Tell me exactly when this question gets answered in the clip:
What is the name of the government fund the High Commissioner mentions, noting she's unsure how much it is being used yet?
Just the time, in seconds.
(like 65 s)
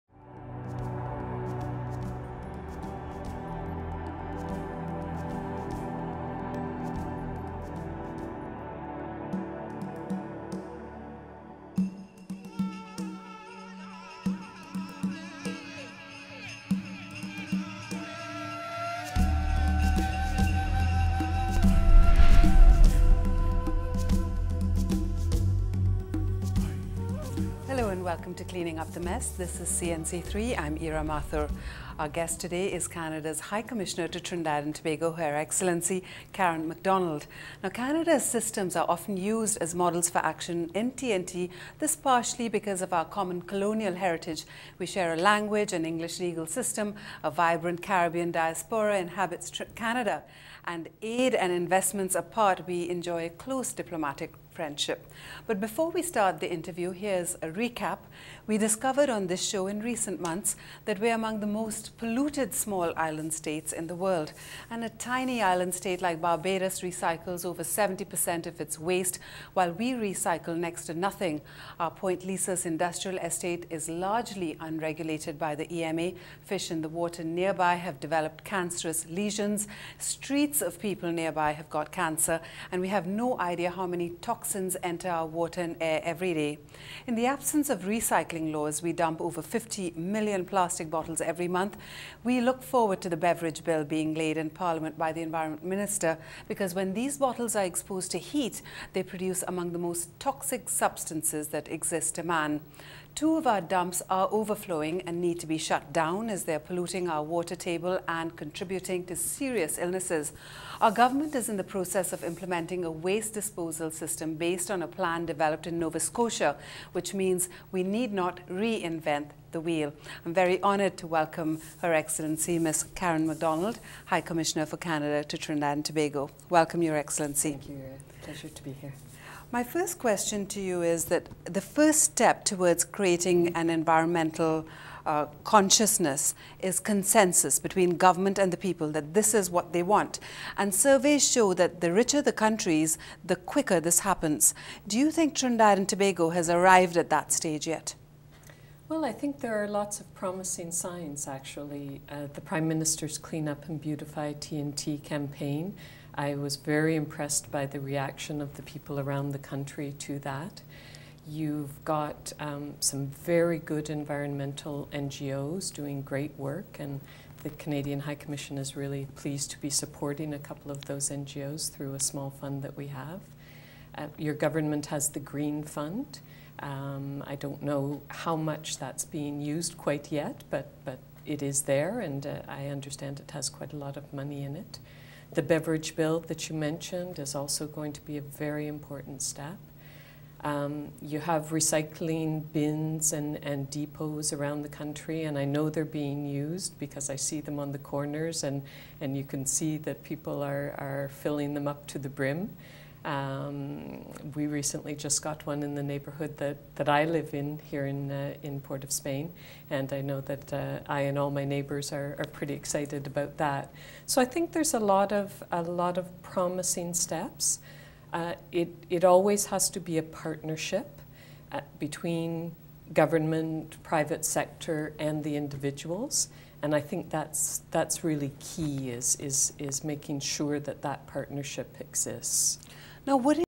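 175 s.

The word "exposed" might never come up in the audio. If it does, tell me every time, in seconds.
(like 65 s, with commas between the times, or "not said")
97 s.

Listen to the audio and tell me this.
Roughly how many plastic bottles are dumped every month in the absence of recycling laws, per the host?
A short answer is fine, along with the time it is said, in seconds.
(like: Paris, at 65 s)
over 50 million, at 89 s.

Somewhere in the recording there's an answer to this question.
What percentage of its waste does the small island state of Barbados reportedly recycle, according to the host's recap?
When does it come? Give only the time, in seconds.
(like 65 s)
67 s.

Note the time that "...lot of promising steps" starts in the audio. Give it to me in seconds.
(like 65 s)
215 s.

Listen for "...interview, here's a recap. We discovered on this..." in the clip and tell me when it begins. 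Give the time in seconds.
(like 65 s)
56 s.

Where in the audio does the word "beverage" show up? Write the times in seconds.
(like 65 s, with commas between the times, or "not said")
93 s, 185 s.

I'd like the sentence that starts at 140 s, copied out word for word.
And surveys show that the richer the countries, the quicker this happens.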